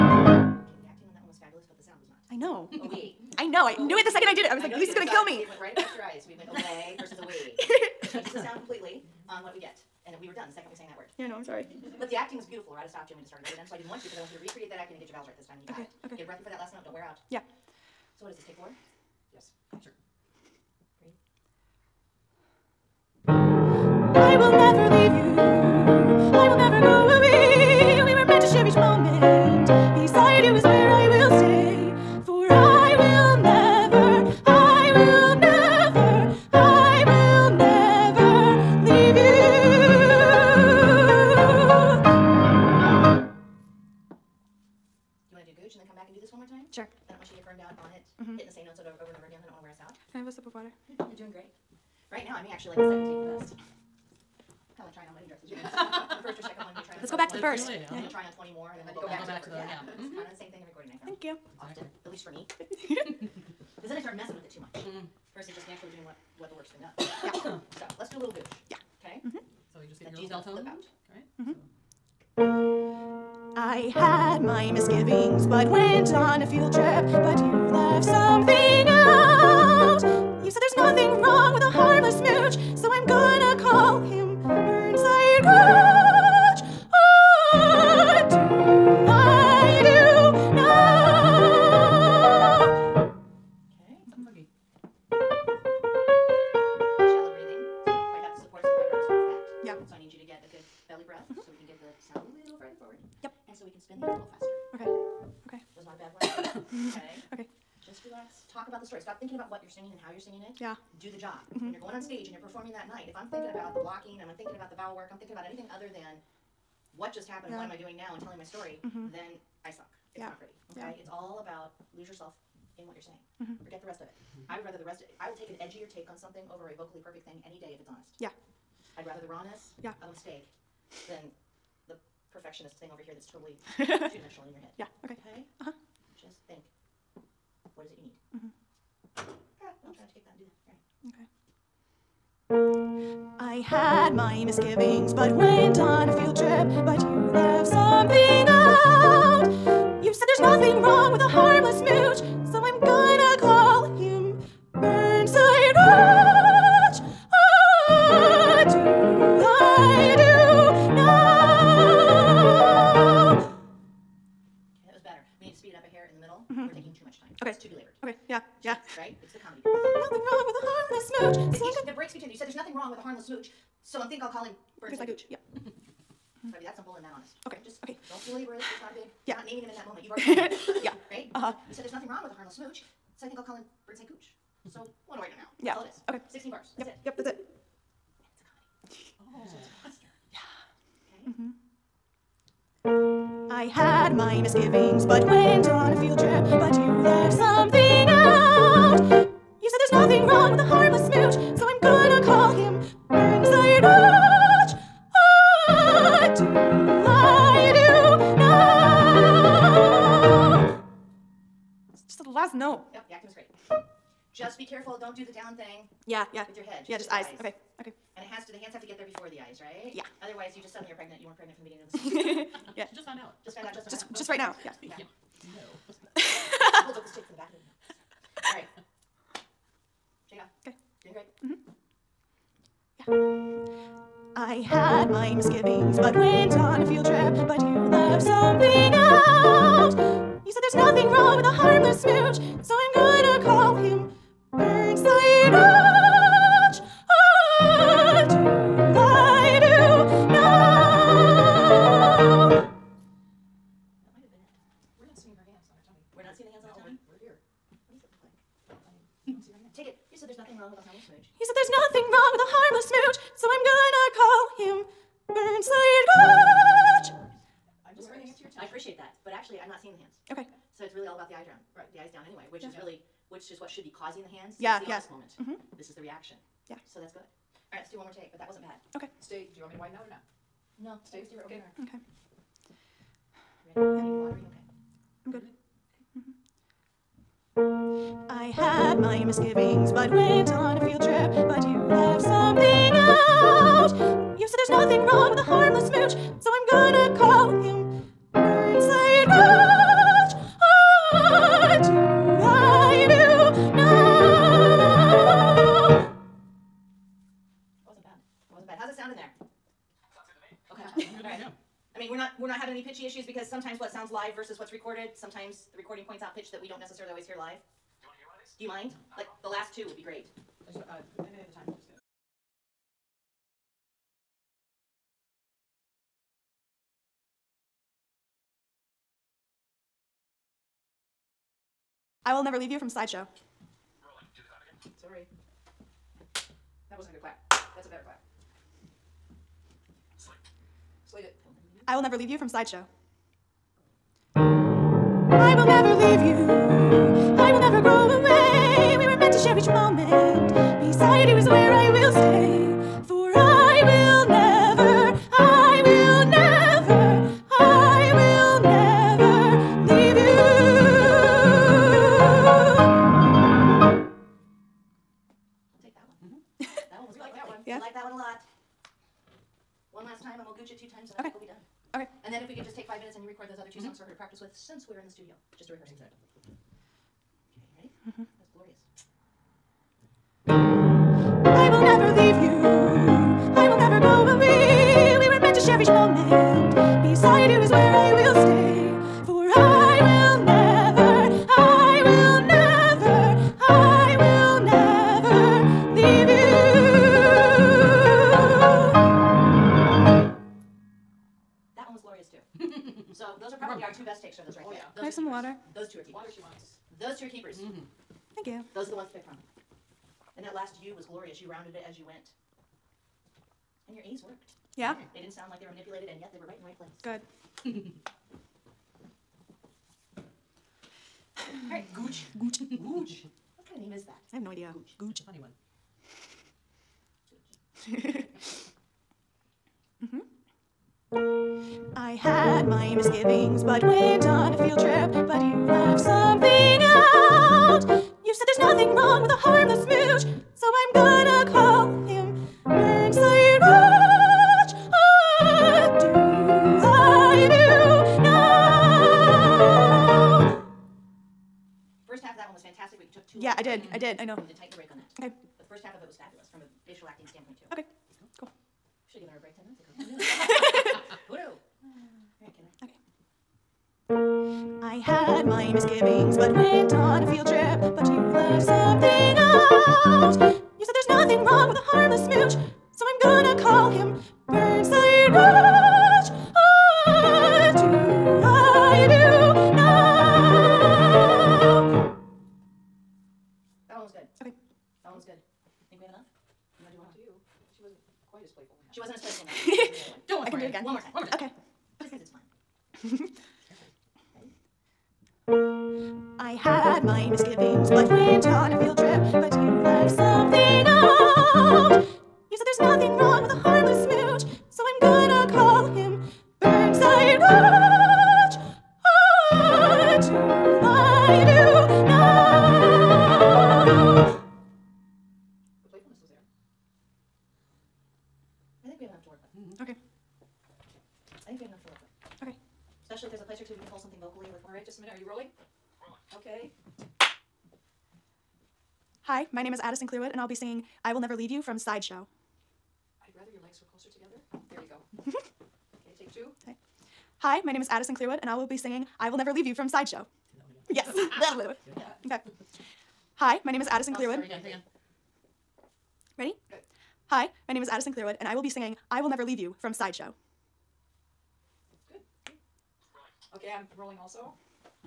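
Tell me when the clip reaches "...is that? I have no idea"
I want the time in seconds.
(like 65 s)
423 s.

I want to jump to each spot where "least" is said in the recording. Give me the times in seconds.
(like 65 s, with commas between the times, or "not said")
62 s.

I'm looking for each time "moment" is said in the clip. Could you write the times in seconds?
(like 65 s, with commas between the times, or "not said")
179 s, 275 s.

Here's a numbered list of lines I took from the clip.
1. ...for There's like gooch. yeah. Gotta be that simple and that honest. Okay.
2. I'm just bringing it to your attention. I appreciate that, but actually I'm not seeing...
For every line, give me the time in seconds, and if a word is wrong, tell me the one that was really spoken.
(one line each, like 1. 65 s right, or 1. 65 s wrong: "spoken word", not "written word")
1. 174 s right
2. 267 s right.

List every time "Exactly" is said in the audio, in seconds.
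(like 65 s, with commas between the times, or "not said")
375 s.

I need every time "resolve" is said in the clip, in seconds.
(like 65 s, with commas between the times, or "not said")
not said.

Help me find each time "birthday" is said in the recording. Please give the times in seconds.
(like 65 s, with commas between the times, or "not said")
not said.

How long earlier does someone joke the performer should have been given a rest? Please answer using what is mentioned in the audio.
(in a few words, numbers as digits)
10 minutes.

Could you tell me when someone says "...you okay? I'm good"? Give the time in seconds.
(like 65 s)
284 s.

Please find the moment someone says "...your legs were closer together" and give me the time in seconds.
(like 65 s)
533 s.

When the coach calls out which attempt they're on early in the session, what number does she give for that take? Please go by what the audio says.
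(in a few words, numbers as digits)
4.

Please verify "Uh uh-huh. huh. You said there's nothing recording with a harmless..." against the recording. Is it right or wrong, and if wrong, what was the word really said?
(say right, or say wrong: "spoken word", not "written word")
wrong: "wrong", not "recording".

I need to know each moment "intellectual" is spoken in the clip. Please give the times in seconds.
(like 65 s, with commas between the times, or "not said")
not said.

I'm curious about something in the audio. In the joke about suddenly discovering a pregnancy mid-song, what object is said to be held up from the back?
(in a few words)
The stick.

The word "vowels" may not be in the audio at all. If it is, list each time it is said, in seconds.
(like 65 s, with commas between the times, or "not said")
15 s, 114 s.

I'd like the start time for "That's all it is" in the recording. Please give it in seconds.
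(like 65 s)
185 s.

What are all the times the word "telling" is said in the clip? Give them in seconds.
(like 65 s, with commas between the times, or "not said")
118 s.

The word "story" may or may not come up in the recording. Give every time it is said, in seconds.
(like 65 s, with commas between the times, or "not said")
108 s, 118 s.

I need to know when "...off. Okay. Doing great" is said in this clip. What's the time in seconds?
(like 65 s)
230 s.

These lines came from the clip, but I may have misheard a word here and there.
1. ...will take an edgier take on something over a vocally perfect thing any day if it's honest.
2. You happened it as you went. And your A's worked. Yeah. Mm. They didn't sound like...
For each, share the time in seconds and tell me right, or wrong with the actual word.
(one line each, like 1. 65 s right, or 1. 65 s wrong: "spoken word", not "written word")
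1. 125 s right
2. 411 s wrong: "rounded", not "happened".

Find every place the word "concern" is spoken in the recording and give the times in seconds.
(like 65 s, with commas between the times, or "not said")
not said.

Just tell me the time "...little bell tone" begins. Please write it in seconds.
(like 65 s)
70 s.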